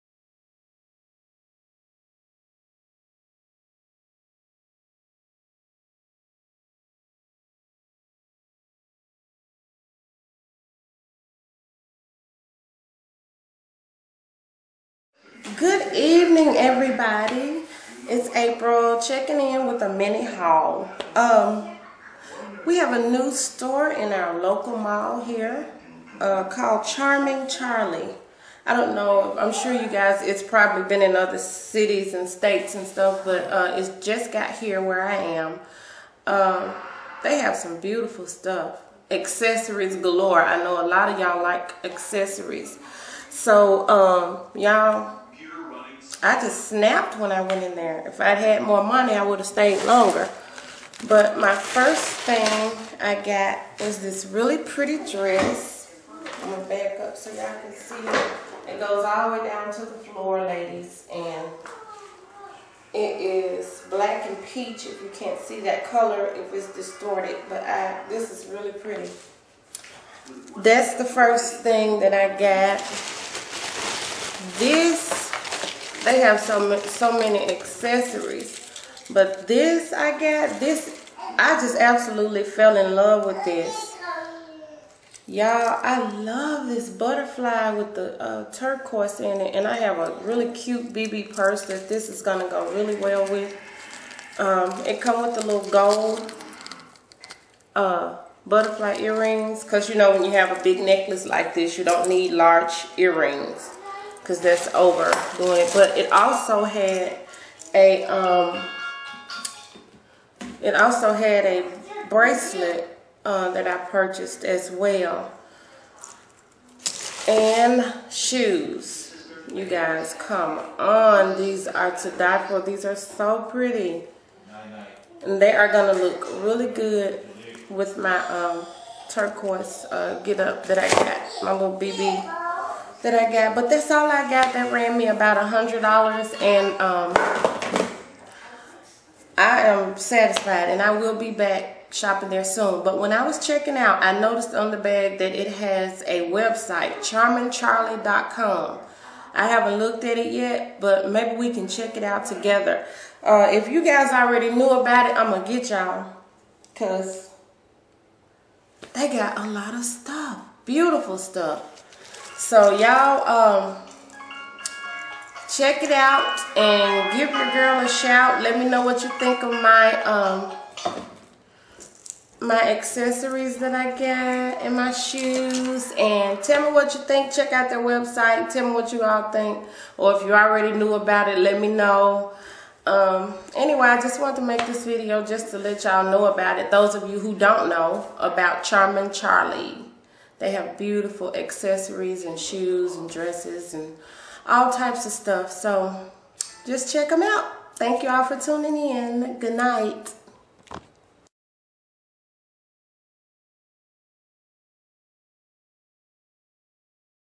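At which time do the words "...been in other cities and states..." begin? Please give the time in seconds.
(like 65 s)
30 s.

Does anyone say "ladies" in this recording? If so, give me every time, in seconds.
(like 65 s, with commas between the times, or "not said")
60 s.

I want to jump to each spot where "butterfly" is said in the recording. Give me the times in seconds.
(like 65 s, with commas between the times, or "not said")
86 s, 98 s.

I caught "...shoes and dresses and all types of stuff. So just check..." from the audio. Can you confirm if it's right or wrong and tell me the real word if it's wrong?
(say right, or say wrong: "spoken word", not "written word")
right.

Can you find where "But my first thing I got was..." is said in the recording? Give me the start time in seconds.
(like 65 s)
51 s.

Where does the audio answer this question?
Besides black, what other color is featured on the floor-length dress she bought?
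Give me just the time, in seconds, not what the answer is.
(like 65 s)
64 s.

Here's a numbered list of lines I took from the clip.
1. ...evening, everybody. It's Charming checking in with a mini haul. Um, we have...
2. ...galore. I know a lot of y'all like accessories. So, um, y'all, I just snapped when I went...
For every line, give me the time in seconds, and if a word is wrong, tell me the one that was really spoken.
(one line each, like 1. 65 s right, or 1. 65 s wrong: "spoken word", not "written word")
1. 15 s wrong: "April", not "Charming"
2. 39 s right.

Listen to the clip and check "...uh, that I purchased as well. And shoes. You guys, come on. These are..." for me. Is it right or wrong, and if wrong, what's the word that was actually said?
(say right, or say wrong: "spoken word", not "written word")
right.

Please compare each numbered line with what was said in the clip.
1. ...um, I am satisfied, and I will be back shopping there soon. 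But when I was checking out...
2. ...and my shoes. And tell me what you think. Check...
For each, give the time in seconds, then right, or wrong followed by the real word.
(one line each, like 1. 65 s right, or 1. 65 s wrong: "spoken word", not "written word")
1. 136 s right
2. 174 s right.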